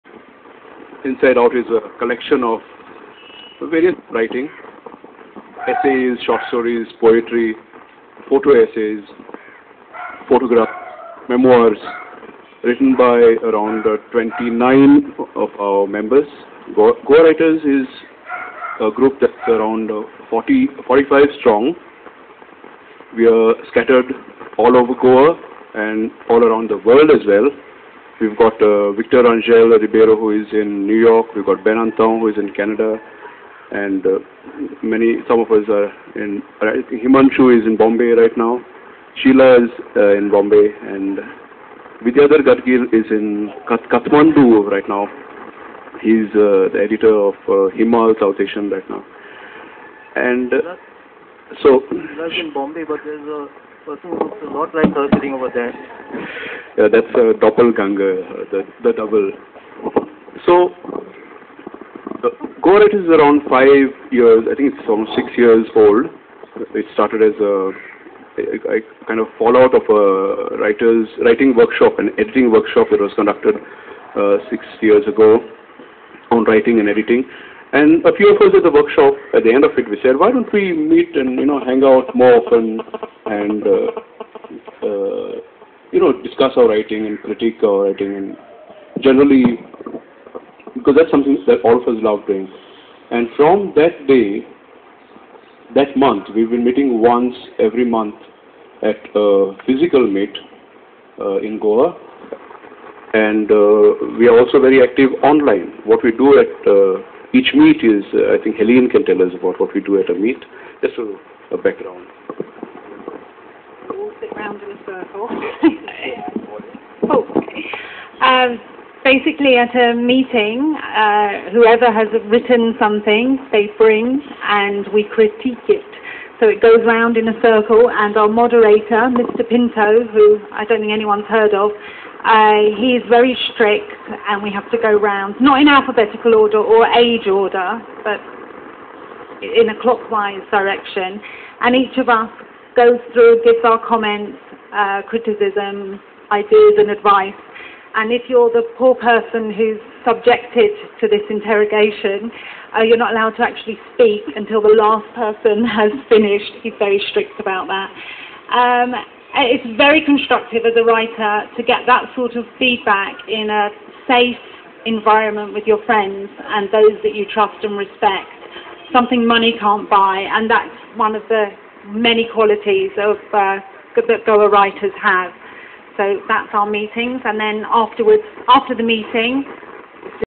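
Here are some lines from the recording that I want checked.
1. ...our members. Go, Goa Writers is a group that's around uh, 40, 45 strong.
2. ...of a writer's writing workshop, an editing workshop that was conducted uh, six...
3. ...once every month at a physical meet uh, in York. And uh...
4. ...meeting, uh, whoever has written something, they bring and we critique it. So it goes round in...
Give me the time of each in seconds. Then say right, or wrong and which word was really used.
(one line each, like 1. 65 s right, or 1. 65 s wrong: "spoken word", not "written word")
1. 15 s right
2. 69 s right
3. 97 s wrong: "Goa", not "York"
4. 119 s right.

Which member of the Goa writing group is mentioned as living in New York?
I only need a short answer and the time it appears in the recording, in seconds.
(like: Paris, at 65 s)
Victor Rangel-Ribeiro, at 28 s.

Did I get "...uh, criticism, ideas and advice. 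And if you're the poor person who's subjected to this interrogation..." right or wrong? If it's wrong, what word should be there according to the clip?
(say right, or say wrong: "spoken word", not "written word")
right.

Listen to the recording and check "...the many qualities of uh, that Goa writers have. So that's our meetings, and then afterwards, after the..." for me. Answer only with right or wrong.
right.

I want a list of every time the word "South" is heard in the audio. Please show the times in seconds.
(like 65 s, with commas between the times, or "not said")
48 s.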